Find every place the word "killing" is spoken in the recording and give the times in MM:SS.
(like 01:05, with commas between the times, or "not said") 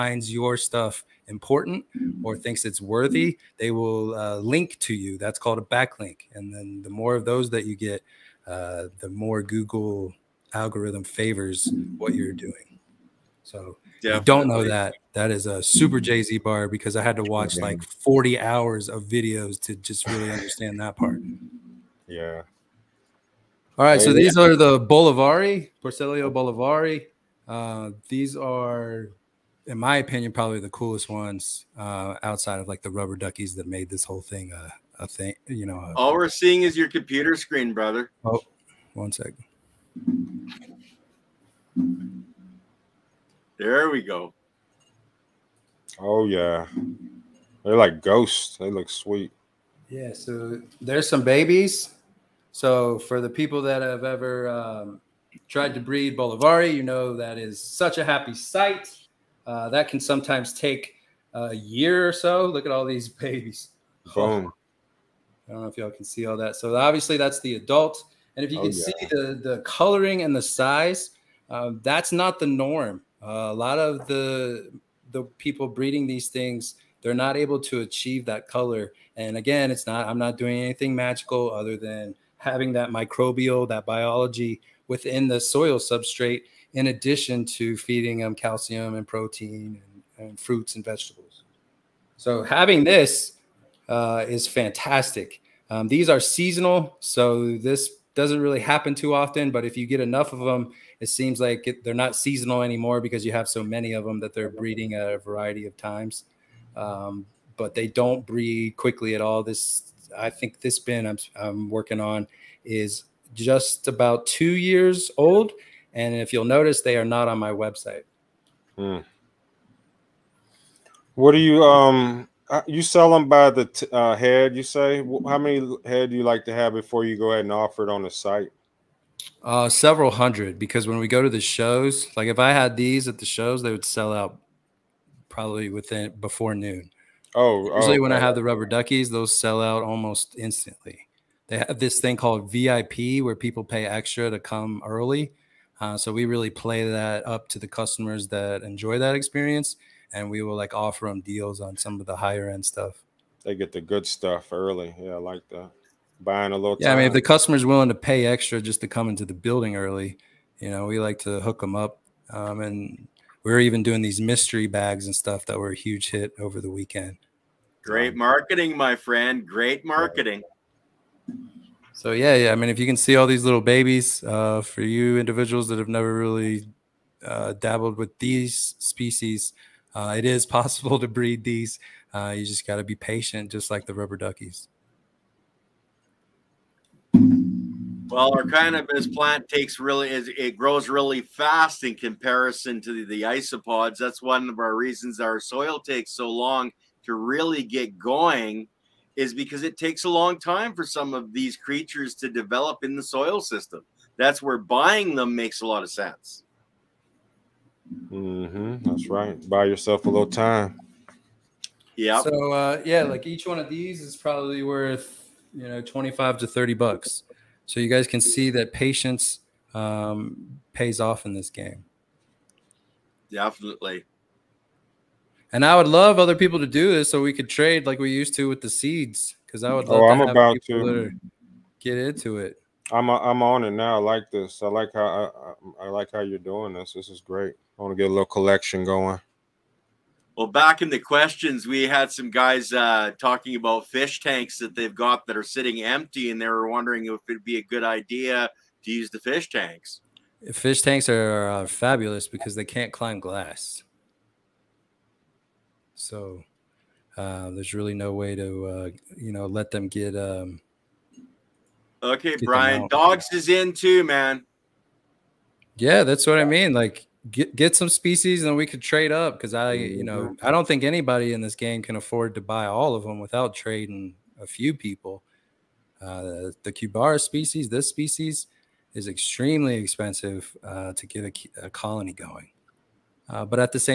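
not said.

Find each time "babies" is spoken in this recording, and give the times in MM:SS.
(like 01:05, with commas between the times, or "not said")
00:51, 01:03, 02:53.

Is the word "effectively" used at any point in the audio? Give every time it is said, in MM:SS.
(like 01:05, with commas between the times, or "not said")
not said.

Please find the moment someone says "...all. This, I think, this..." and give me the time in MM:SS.
01:49.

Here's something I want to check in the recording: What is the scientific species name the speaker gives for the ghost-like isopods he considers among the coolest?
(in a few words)
Porcellio Bolivari.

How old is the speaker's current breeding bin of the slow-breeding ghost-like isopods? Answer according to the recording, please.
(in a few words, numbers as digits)
about 2 years.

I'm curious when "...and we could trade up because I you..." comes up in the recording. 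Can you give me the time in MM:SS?
04:28.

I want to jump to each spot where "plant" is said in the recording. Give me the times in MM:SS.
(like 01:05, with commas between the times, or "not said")
03:09.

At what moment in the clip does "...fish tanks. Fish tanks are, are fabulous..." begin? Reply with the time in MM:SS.
04:09.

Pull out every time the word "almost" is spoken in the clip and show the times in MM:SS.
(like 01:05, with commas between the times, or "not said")
02:19.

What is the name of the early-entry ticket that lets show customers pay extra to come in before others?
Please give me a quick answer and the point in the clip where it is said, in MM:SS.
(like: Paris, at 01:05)
VIP, at 02:22.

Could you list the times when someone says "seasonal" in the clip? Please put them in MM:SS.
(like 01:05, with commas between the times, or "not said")
01:36, 01:42.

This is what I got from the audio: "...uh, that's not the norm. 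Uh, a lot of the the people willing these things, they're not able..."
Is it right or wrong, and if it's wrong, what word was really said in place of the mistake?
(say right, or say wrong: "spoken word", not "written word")
wrong: "breeding", not "willing".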